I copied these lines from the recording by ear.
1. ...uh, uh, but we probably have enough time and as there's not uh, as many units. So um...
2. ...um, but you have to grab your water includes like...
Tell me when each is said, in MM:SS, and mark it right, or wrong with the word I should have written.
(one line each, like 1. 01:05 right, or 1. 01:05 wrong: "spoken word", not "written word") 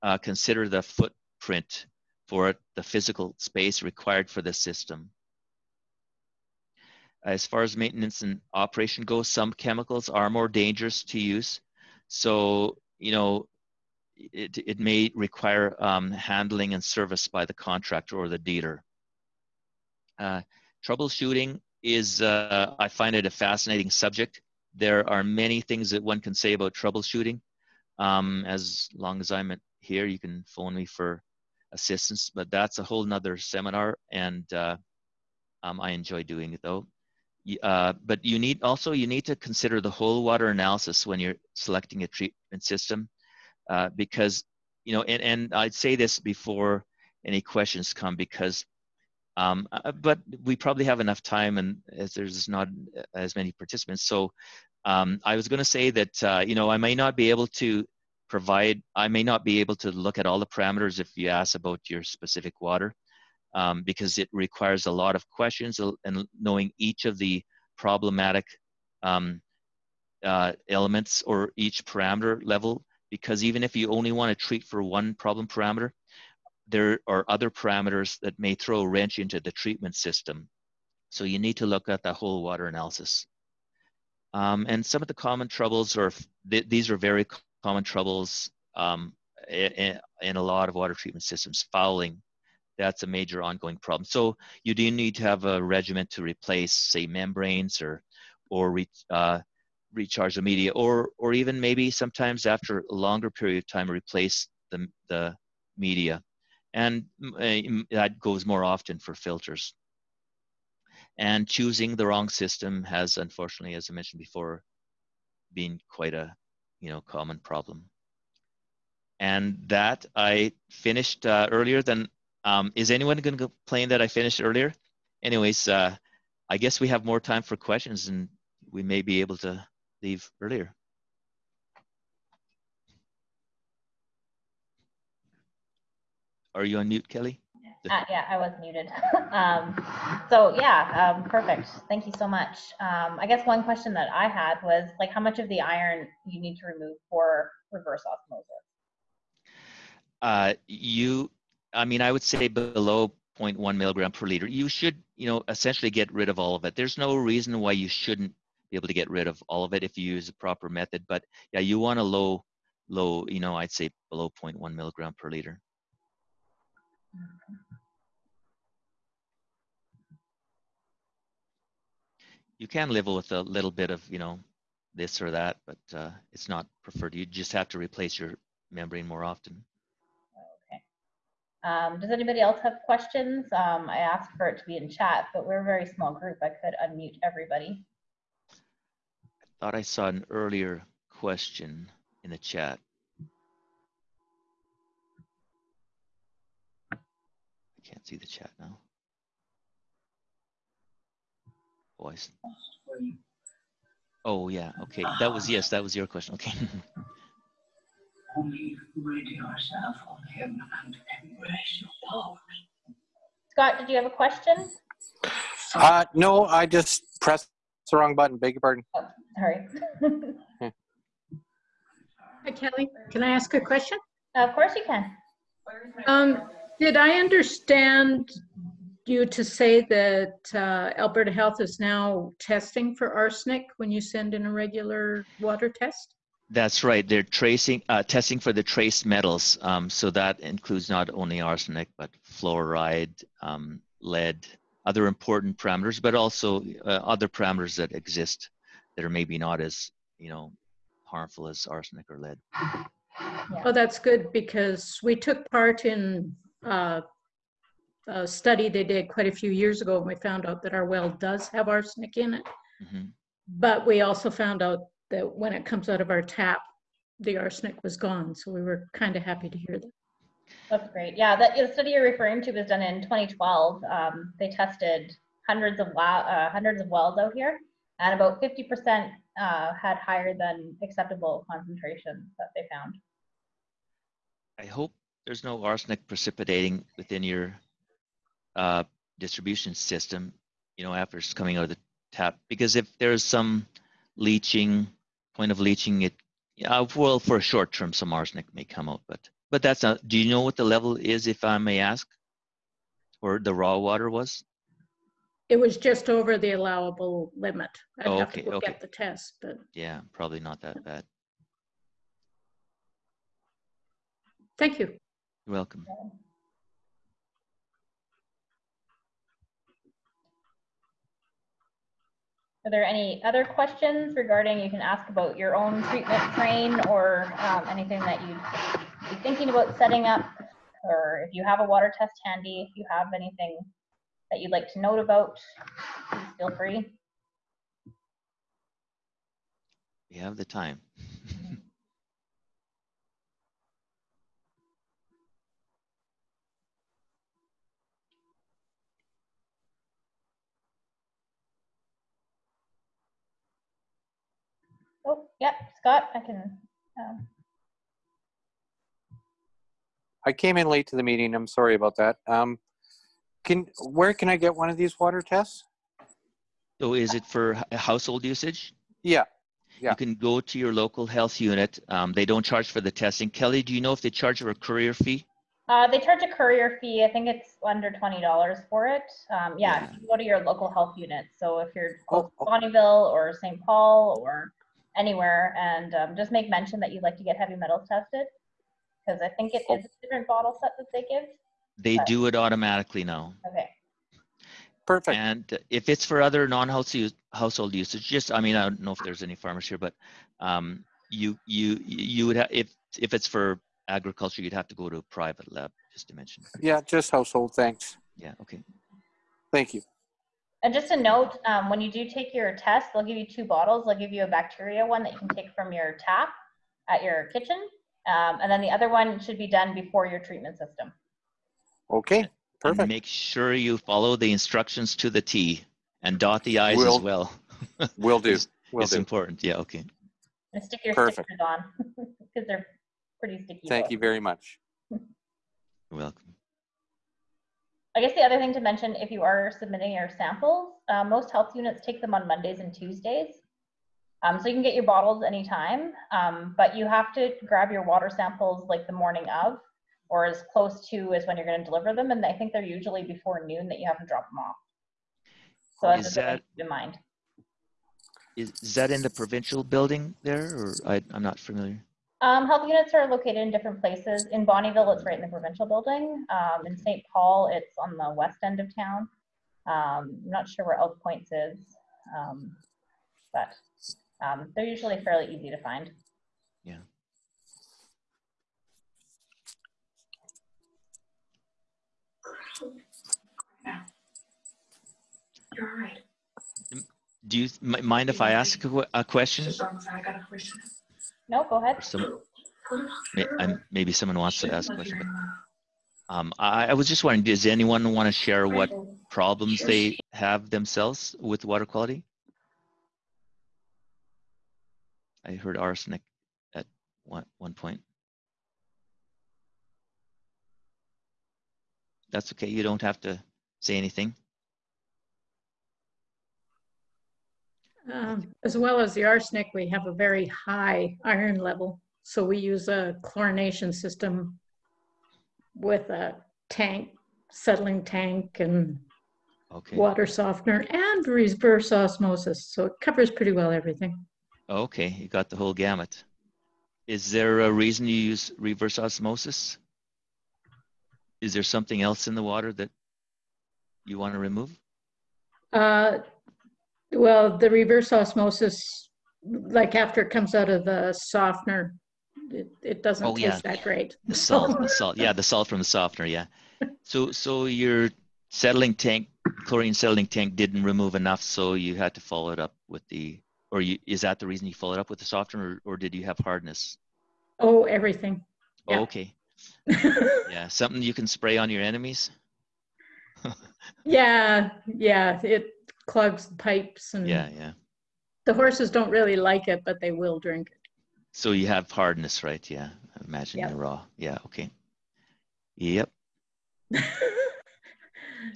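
1. 00:49 wrong: "participants", not "units"
2. 07:26 wrong: "samples", not "includes".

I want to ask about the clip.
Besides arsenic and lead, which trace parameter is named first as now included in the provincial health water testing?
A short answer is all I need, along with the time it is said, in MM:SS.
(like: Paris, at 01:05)
Fluoride, at 04:02.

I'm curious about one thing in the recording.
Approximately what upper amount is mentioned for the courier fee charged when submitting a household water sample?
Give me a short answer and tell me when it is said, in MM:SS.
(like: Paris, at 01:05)
Under $20, at 06:17.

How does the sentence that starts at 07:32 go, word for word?
And I think they're usually before noon that you have to drop them off.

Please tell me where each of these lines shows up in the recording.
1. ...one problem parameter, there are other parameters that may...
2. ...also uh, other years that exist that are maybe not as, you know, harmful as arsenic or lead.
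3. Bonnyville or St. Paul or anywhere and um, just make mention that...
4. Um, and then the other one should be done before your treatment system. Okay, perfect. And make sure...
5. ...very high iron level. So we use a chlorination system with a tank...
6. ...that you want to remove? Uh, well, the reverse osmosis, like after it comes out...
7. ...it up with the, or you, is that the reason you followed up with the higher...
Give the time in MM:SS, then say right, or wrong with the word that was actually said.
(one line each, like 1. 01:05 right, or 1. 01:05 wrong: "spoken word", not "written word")
1. 01:14 right
2. 04:06 wrong: "parameters", not "years"
3. 06:22 right
4. 06:58 right
5. 08:39 right
6. 09:02 right
7. 09:22 wrong: "softener", not "higher".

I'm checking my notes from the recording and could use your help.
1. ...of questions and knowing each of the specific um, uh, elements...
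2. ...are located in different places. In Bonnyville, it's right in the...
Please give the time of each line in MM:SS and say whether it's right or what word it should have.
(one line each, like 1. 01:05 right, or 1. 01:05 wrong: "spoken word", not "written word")
1. 01:05 wrong: "problematic", not "specific"
2. 07:42 right.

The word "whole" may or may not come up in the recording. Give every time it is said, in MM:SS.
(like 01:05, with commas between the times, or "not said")
00:32, 00:39, 01:22, 08:55.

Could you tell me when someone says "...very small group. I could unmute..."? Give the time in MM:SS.
03:05.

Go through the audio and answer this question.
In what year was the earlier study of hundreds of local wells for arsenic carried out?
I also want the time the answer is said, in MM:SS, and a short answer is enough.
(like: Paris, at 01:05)
2012, at 04:33.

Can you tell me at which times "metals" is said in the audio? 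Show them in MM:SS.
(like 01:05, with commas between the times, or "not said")
03:59, 06:27.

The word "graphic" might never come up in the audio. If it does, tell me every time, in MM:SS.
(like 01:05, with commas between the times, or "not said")
not said.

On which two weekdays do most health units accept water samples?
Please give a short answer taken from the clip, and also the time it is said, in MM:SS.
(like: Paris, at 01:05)
Mondays and Tuesdays, at 07:22.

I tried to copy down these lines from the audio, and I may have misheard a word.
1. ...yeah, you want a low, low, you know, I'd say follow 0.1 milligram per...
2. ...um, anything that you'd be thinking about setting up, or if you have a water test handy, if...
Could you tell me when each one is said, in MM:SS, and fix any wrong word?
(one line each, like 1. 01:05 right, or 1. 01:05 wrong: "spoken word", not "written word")
1. 02:41 wrong: "below", not "follow"
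2. 05:27 right.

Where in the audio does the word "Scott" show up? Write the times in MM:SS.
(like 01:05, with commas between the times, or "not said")
03:33, 05:55.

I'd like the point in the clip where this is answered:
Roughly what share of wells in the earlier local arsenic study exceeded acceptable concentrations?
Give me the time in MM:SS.
04:38.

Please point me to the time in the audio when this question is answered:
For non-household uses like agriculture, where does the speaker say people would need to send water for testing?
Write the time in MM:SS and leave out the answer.
06:45.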